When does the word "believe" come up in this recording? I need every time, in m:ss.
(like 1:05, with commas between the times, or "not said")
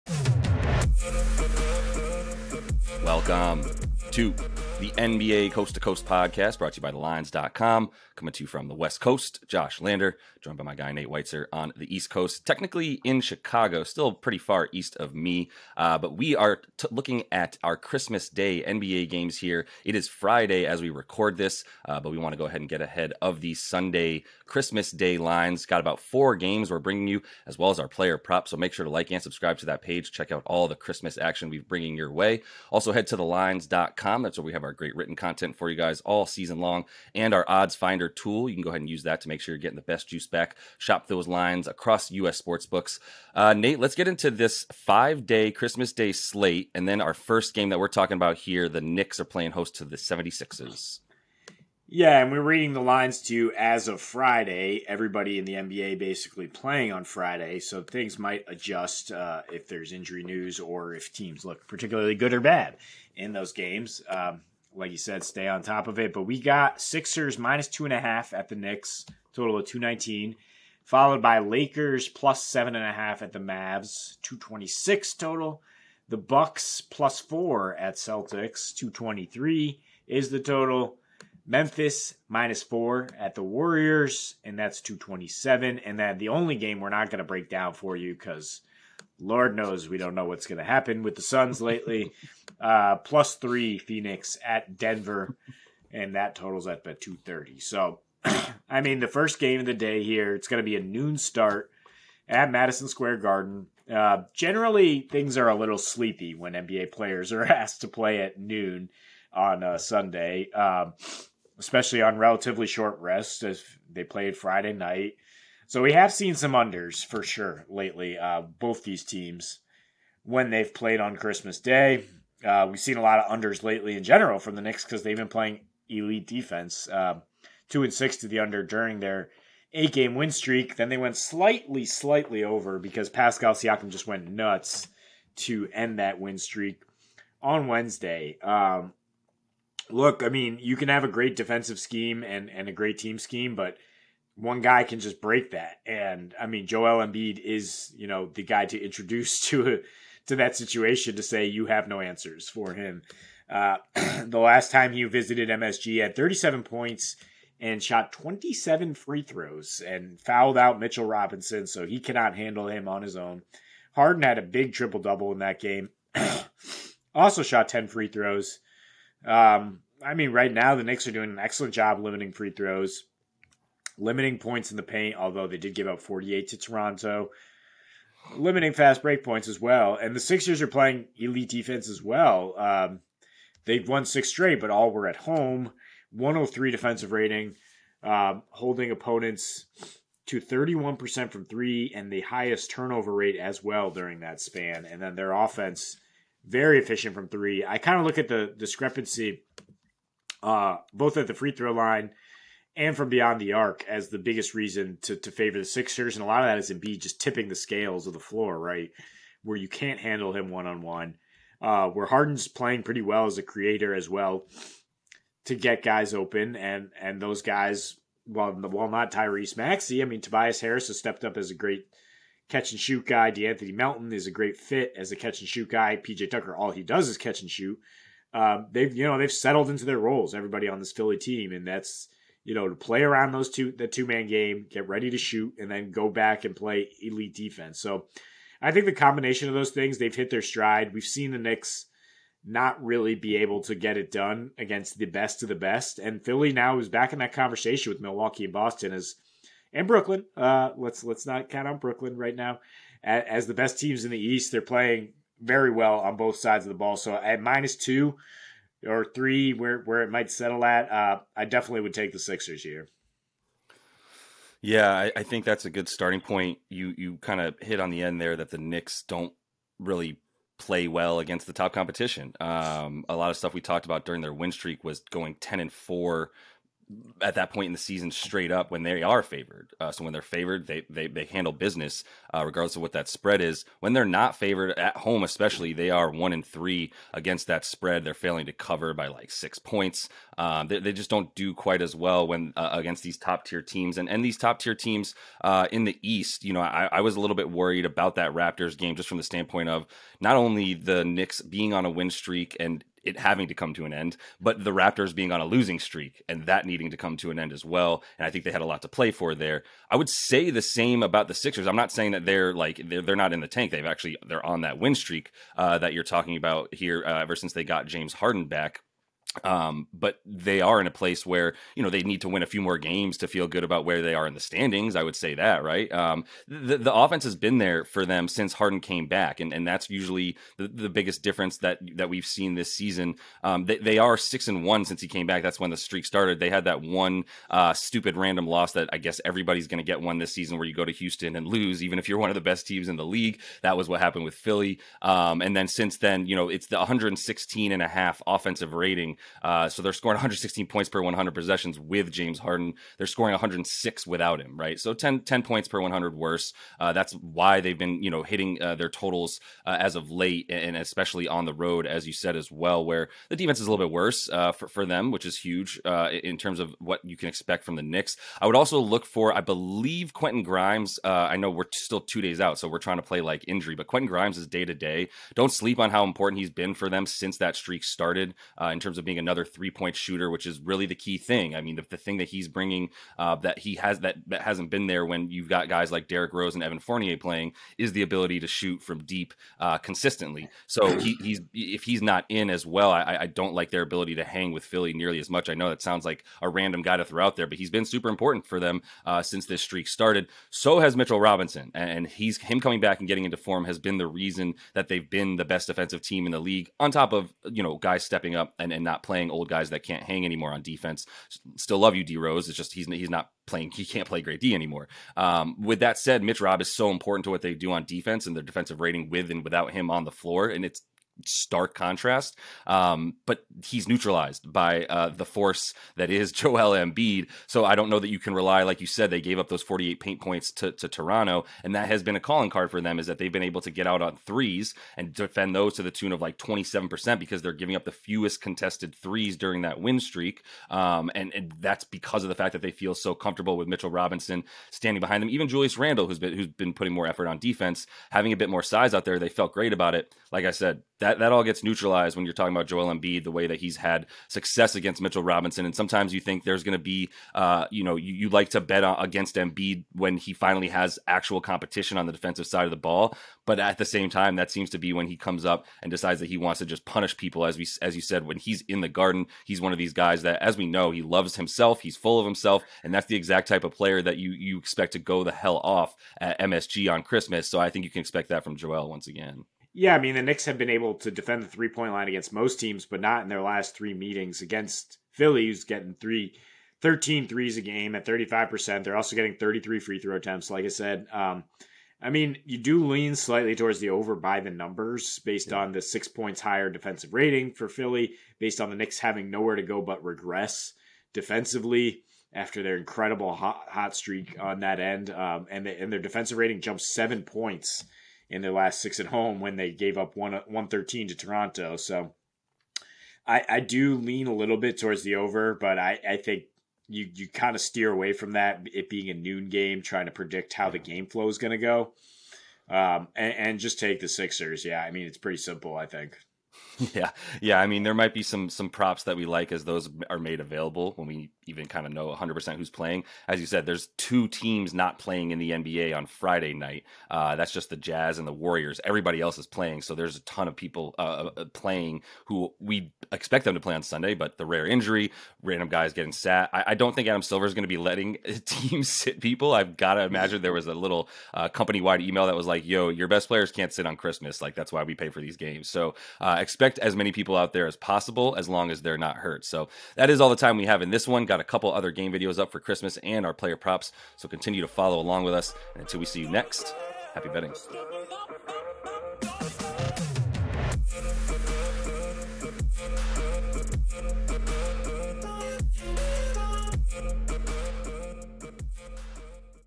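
6:09.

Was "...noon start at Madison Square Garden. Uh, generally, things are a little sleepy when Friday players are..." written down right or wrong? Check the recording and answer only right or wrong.
wrong.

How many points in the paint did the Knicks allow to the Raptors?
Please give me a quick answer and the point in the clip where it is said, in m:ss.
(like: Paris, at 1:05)
48, at 7:09.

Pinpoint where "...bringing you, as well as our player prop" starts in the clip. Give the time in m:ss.
0:26.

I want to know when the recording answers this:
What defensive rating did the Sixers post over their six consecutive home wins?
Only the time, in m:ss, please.
3:06.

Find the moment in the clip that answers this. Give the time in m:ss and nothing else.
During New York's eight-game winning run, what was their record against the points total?
2:07.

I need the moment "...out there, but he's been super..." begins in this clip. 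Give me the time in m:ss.
6:37.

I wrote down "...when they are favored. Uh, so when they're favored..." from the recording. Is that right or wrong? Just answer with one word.
right.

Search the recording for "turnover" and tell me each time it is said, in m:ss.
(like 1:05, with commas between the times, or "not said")
3:12.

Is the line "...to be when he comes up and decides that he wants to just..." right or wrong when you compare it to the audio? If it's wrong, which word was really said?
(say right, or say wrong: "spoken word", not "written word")
right.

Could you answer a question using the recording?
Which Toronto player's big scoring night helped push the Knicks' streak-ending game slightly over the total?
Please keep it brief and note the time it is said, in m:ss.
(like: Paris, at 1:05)
Pascal Siakam, at 2:13.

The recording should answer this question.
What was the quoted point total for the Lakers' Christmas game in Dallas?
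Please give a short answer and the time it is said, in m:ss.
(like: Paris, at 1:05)
226, at 1:14.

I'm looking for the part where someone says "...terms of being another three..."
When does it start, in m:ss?
6:18.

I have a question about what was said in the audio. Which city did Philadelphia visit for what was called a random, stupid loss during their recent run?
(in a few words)
Houston.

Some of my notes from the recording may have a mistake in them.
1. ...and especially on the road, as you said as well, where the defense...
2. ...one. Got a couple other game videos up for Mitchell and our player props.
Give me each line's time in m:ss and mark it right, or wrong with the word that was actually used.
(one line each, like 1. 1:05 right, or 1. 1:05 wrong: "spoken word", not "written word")
1. 6:00 right
2. 9:21 wrong: "Christmas", not "Mitchell".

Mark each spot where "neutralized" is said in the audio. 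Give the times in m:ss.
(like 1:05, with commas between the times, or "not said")
7:03, 7:31.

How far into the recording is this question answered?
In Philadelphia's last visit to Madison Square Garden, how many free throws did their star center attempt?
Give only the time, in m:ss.
2:38.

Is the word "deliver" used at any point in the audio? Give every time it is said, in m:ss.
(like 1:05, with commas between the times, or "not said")
not said.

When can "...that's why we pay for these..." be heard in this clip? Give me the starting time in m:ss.
9:14.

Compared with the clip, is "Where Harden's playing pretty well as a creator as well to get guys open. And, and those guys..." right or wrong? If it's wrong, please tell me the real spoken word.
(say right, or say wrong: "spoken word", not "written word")
right.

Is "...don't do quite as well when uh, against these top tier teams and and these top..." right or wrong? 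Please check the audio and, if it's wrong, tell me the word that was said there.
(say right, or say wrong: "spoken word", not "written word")
right.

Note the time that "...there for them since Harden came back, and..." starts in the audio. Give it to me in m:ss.
5:27.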